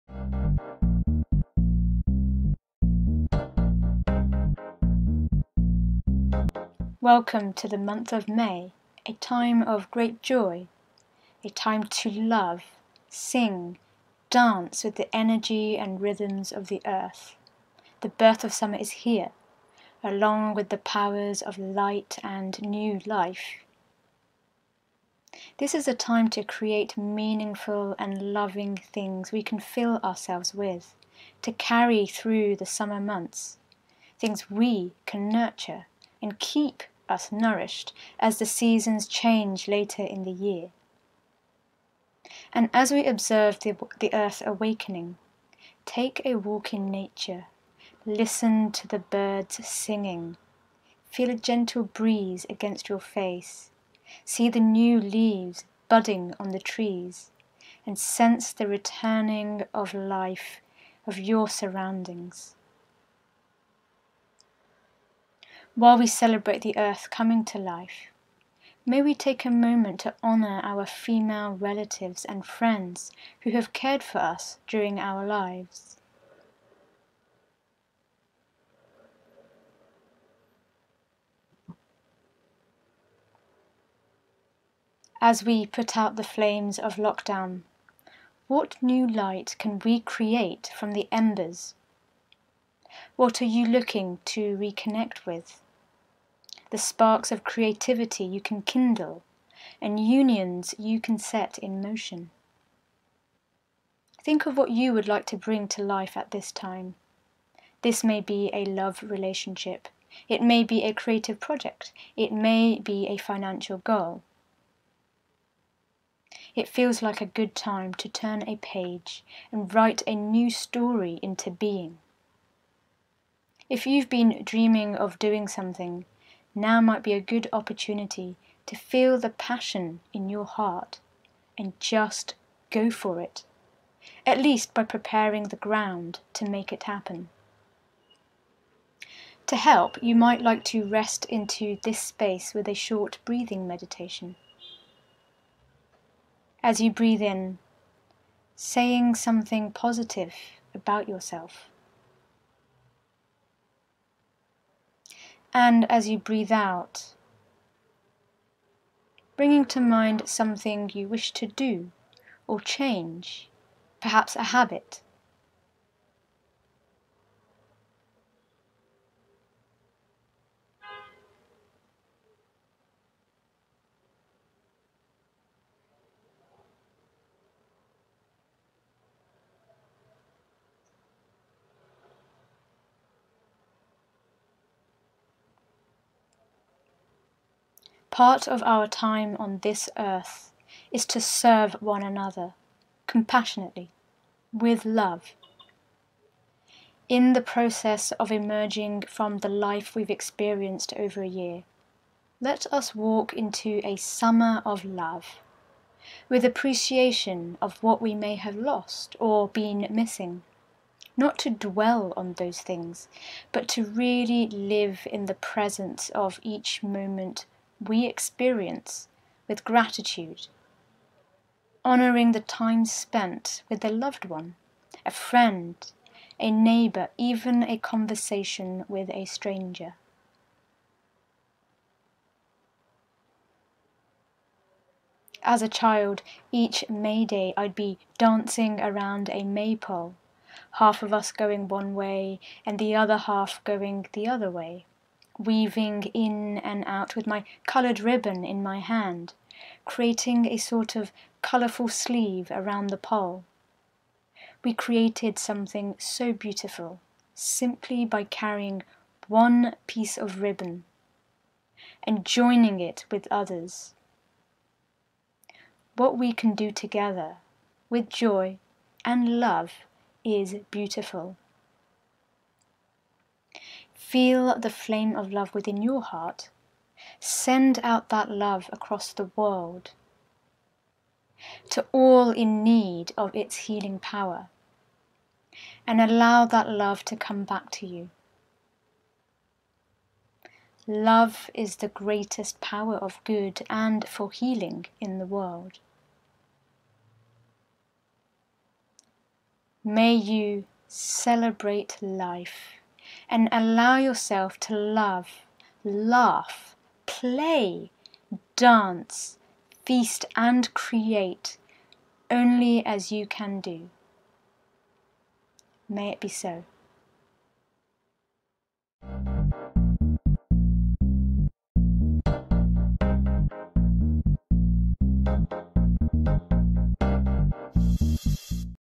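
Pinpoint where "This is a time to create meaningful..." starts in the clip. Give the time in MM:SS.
00:25.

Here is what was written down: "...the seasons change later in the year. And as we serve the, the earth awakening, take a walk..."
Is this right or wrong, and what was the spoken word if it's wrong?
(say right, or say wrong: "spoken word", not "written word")
wrong: "observe", not "serve".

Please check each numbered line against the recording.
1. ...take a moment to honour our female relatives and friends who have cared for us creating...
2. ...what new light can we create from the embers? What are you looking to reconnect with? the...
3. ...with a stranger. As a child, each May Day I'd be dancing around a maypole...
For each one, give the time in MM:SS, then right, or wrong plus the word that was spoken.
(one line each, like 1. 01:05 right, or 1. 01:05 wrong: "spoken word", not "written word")
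1. 01:09 wrong: "during", not "creating"
2. 01:28 right
3. 03:48 right.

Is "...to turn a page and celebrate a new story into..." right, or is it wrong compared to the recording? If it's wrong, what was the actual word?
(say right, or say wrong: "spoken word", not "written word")
wrong: "write", not "celebrate".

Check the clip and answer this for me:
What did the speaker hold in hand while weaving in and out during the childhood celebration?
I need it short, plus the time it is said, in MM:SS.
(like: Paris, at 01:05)
Coloured ribbon, at 04:07.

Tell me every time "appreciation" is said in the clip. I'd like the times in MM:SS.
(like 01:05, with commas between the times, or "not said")
03:26.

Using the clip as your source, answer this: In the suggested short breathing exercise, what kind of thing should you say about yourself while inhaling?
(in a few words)
Something positive.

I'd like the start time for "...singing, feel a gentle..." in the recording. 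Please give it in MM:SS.
00:49.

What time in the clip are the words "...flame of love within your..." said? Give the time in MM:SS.
04:34.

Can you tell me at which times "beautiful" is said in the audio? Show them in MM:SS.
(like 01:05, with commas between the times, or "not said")
04:16, 04:30.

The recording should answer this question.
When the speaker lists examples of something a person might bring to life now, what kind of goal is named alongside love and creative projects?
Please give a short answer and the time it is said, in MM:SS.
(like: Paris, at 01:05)
A financial goal, at 01:53.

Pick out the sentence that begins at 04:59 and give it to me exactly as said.
May you celebrate life and allow yourself to love, laugh, play, dance, feast, and create only as you can do.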